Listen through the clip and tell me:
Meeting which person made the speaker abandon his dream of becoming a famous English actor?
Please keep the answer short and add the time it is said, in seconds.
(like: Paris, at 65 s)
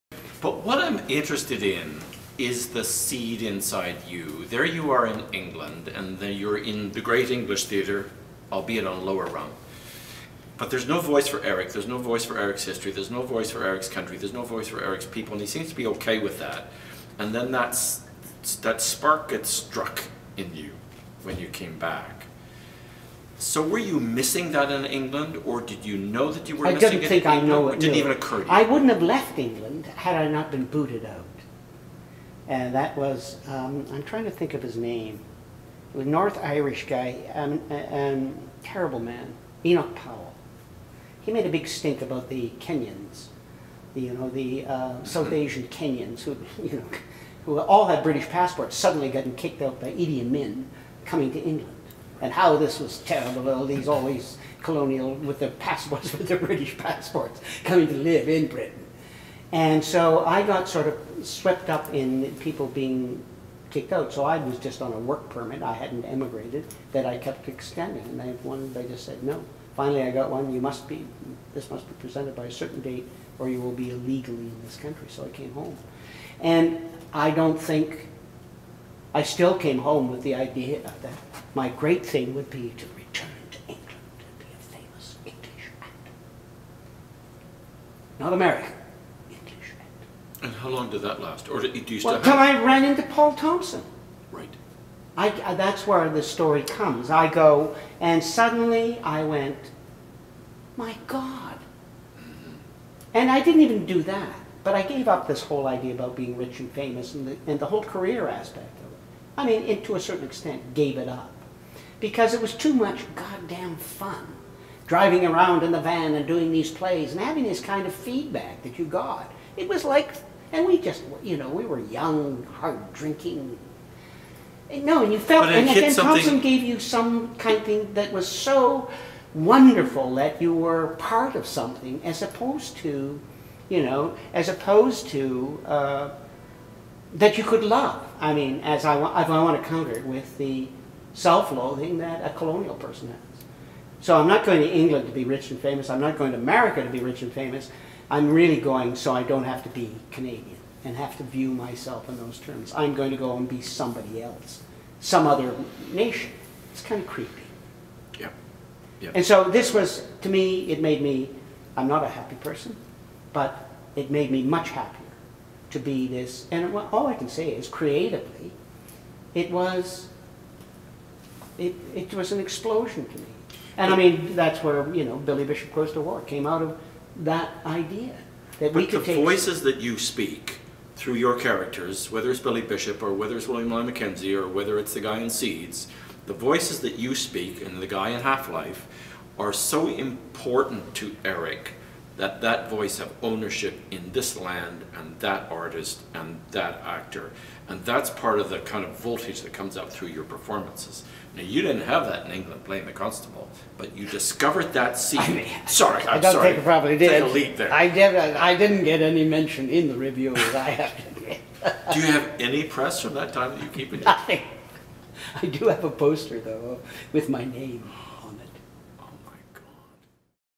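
Paul Thompson, at 93 s.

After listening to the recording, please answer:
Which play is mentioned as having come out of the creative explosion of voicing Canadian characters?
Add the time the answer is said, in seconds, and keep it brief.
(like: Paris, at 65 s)
Billy Bishop Goes to War, at 175 s.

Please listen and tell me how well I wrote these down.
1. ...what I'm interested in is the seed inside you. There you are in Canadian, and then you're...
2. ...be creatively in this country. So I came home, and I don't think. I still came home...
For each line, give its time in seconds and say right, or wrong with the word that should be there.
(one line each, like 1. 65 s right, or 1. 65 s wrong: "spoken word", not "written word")
1. 0 s wrong: "England", not "Canadian"
2. 73 s wrong: "illegally", not "creatively".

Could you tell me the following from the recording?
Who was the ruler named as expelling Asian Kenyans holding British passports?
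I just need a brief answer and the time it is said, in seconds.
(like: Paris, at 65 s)
Idi Amin, at 49 s.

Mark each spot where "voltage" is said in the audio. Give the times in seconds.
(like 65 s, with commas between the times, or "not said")
198 s.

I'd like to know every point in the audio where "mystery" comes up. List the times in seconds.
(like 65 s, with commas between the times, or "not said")
not said.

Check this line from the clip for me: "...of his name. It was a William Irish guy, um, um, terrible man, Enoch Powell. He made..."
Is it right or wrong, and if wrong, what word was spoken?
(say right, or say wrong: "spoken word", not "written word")
wrong: "North", not "William".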